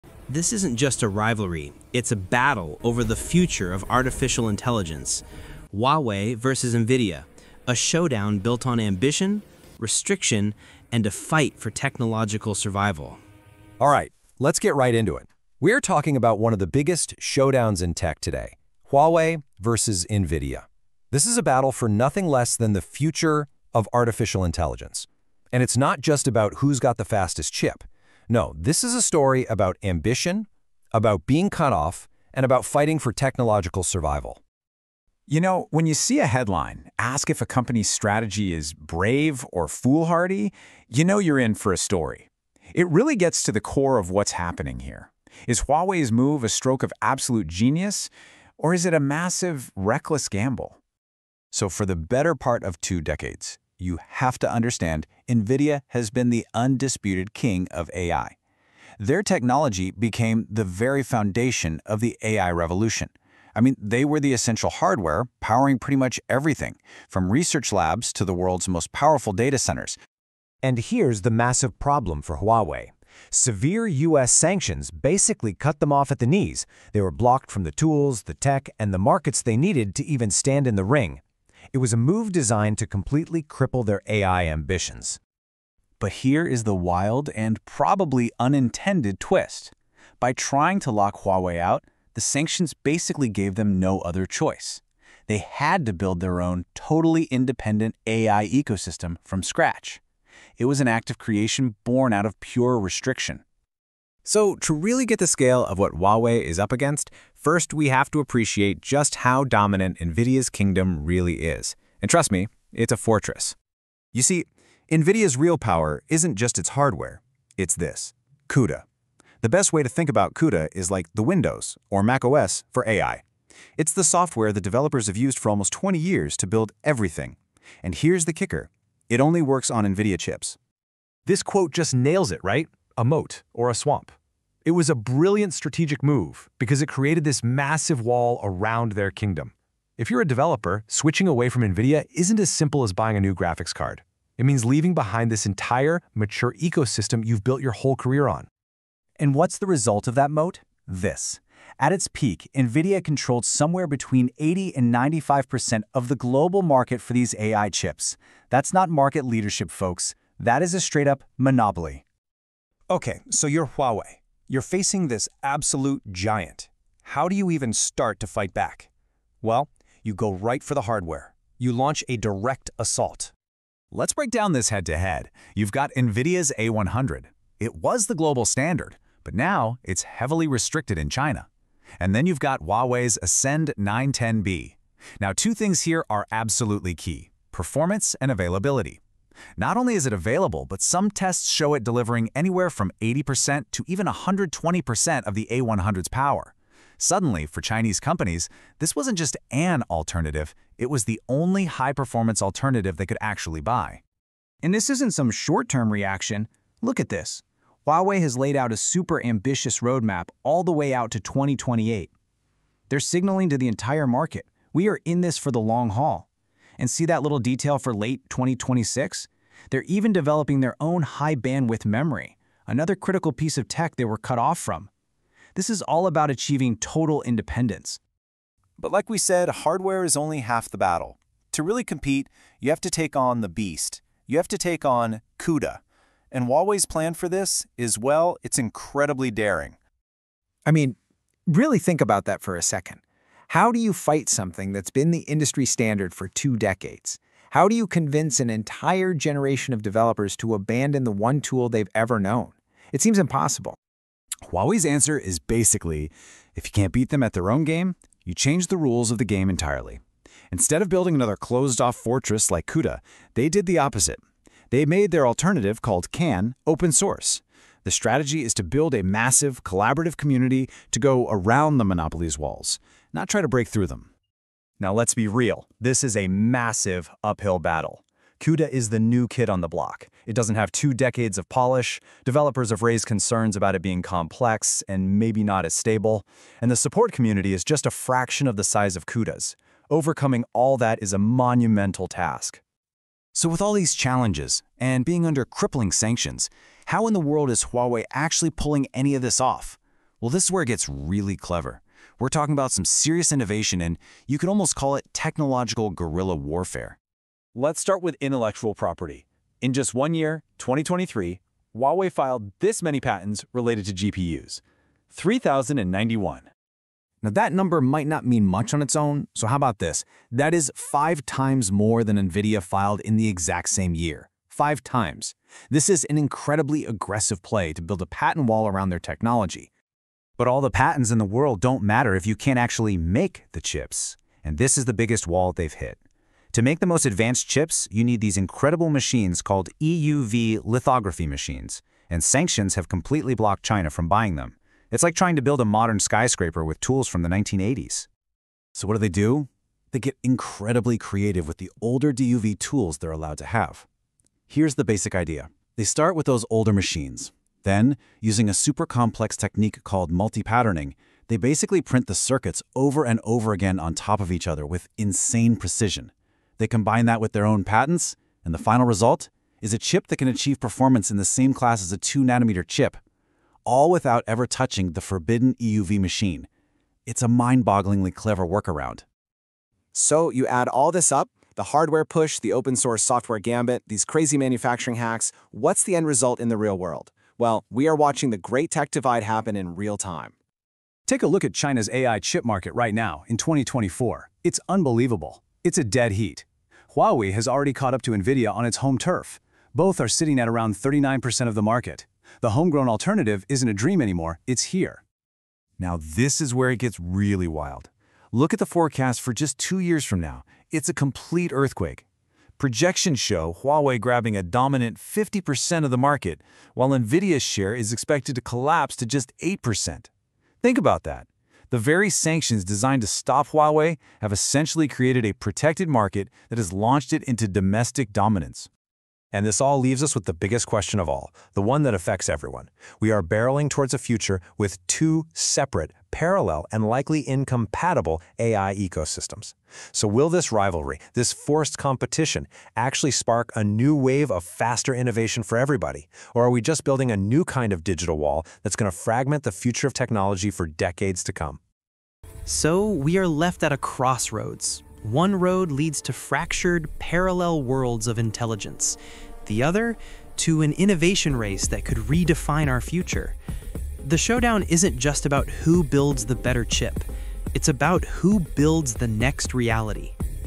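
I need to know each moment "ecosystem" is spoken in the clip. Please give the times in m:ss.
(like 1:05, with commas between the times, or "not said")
1:38, 2:26, 7:18.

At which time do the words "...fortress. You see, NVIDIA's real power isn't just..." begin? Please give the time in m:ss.
1:52.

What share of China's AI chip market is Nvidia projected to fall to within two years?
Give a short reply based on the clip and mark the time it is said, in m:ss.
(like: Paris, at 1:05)
8%, at 6:59.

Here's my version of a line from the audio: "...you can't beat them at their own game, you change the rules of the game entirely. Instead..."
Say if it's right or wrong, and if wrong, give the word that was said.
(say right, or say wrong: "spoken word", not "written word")
right.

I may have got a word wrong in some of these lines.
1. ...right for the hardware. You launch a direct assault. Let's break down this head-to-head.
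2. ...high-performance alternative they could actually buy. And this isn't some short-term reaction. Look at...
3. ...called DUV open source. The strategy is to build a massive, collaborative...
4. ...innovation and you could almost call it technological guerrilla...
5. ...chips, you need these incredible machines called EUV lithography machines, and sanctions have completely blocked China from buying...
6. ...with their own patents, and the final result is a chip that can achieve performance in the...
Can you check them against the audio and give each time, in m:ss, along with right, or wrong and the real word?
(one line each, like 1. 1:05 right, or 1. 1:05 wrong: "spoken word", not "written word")
1. 2:50 right
2. 3:21 right
3. 4:25 wrong: "CANN", not "DUV"
4. 5:03 right
5. 5:37 right
6. 6:07 right.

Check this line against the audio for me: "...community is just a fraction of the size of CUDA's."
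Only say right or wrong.
right.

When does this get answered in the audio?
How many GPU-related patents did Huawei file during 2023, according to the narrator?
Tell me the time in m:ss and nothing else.
5:15.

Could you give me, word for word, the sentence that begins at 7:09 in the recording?
And this all leaves us with the biggest question of all, the one that affects everyone.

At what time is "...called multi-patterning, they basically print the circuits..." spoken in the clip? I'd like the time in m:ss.
5:59.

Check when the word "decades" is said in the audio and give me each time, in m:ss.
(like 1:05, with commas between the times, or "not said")
0:53, 4:06, 4:40, 7:30.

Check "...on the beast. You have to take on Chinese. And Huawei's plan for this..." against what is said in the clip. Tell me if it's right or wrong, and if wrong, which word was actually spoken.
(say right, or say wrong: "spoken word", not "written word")
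wrong: "CUDA", not "Chinese".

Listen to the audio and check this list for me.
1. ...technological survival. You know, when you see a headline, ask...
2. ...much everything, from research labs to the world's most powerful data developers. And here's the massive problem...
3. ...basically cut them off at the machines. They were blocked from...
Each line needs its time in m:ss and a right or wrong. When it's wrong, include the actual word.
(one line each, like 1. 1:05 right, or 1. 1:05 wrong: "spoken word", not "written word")
1. 0:33 right
2. 1:05 wrong: "centers", not "developers"
3. 1:14 wrong: "knees", not "machines".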